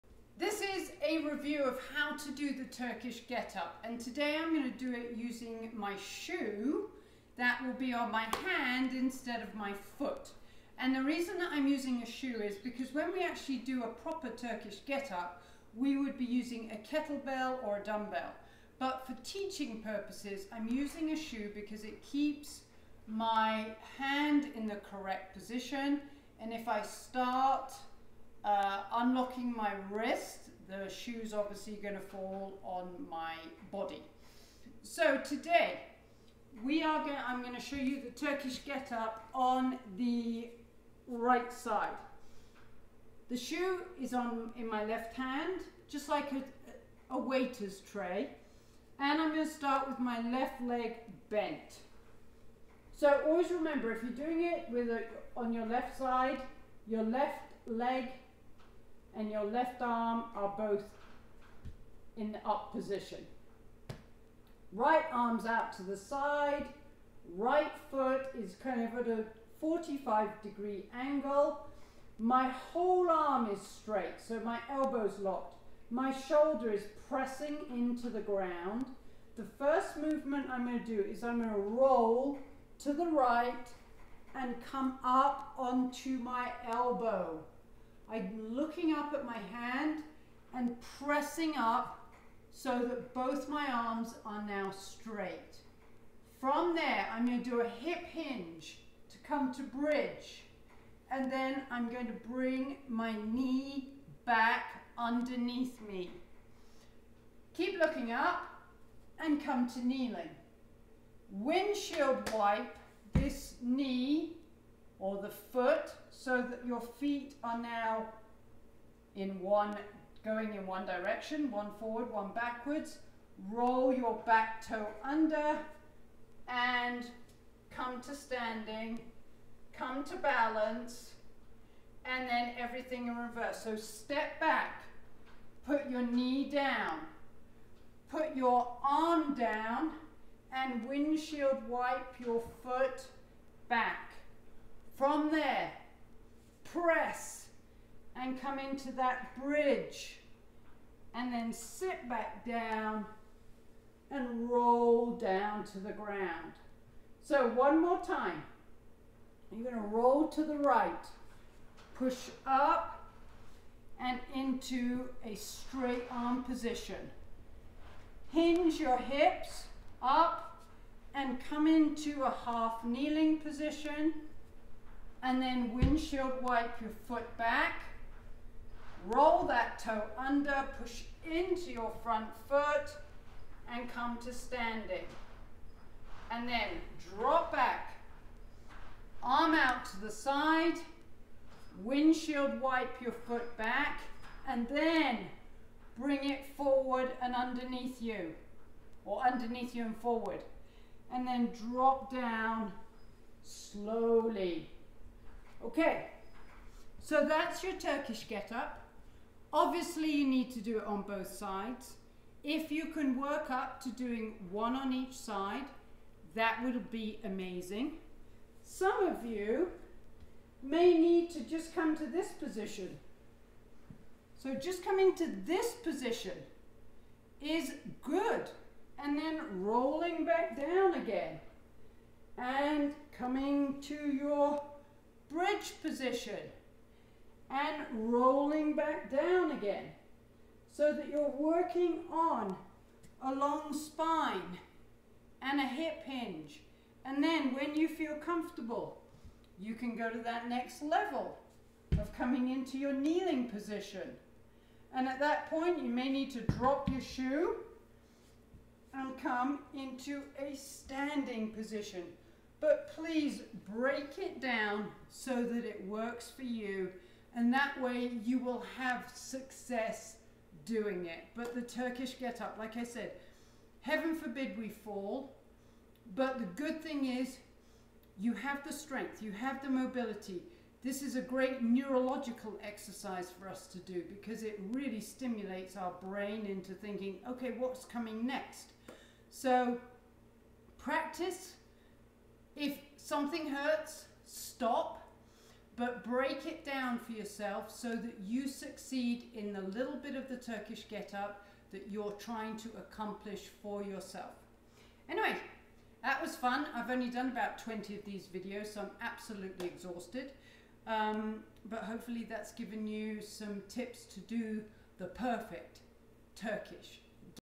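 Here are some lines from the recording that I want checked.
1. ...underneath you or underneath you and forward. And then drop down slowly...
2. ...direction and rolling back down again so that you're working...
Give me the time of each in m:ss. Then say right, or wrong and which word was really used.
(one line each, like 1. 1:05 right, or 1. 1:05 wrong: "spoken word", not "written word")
1. 3:17 right
2. 3:55 wrong: "position", not "direction".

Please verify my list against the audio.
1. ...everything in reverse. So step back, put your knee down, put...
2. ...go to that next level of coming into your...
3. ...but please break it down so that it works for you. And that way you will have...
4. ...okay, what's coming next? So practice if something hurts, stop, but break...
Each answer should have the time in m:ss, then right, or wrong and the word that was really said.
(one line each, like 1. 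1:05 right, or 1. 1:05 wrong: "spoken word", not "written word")
1. 2:12 right
2. 4:09 right
3. 4:22 right
4. 4:47 right.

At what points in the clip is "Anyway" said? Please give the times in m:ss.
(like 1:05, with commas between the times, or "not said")
5:05.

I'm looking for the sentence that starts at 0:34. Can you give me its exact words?
So today we are going I'm going to show you the Turkish get up on the right side.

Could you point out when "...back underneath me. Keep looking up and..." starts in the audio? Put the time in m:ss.
1:44.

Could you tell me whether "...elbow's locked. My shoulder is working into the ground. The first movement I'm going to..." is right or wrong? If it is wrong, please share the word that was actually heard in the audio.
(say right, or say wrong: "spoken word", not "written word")
wrong: "pressing", not "working".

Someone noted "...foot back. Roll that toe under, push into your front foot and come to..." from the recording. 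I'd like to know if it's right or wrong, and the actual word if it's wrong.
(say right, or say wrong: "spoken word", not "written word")
right.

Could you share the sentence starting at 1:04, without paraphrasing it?
Right arm's out to the side, right foot is kind of at a 45 degree angle.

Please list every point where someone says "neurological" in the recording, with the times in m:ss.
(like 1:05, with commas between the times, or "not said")
4:41.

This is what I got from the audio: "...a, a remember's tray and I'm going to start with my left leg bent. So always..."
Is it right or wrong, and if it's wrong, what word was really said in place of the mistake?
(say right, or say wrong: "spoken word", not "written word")
wrong: "waiter", not "remember".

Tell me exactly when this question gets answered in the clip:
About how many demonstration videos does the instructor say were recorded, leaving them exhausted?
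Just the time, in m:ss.
5:07.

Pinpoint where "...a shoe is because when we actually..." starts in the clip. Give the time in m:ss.
0:12.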